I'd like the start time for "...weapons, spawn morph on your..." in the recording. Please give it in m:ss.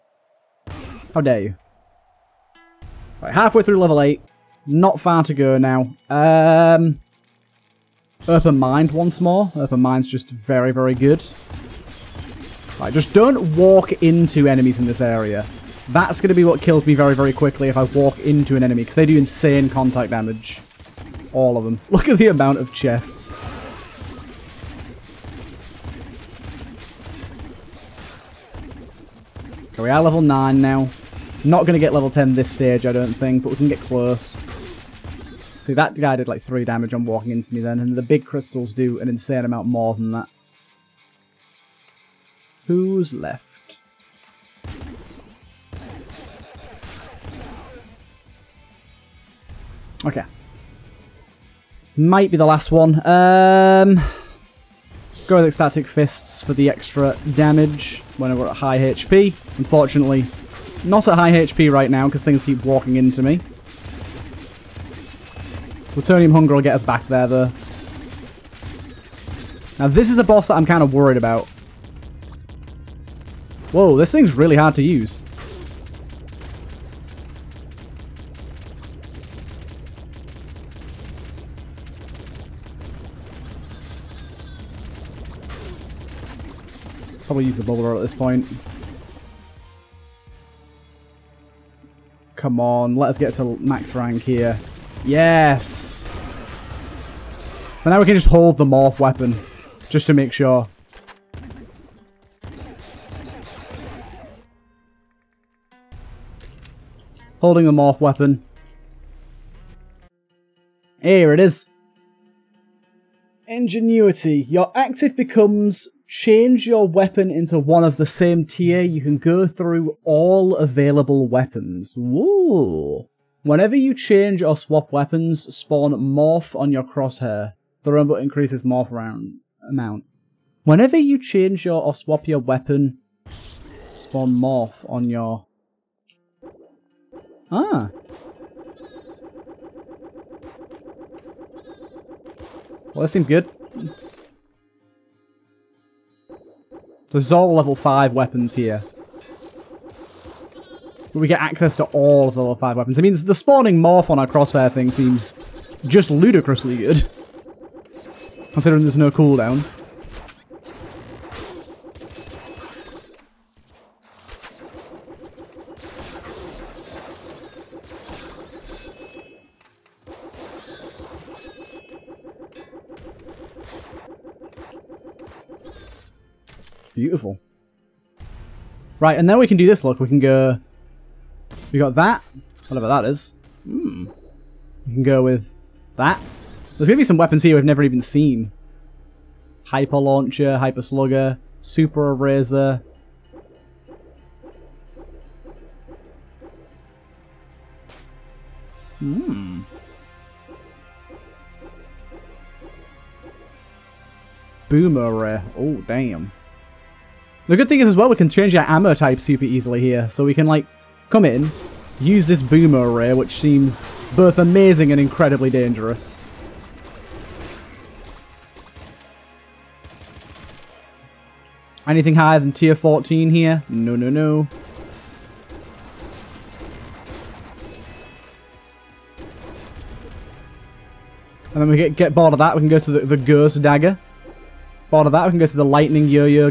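2:04.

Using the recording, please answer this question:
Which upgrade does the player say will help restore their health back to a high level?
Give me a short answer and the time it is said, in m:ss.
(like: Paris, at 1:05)
Plutonium Hunger, at 1:05.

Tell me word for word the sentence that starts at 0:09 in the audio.
Open Mind's just very, very good.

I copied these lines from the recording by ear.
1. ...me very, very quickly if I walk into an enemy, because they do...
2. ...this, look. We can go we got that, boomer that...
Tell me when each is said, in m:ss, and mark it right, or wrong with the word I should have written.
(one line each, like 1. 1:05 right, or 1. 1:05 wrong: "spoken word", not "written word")
1. 0:16 right
2. 2:59 wrong: "whatever", not "boomer".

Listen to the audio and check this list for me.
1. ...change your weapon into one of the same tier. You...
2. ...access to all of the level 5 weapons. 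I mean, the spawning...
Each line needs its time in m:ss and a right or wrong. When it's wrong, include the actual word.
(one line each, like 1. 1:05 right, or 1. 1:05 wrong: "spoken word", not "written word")
1. 1:56 right
2. 2:31 right.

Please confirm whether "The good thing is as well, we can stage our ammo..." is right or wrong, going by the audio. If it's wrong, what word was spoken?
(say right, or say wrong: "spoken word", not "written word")
wrong: "change", not "stage".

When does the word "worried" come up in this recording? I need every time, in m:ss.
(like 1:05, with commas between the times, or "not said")
1:10.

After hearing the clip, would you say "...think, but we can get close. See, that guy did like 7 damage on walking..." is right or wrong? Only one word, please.
wrong.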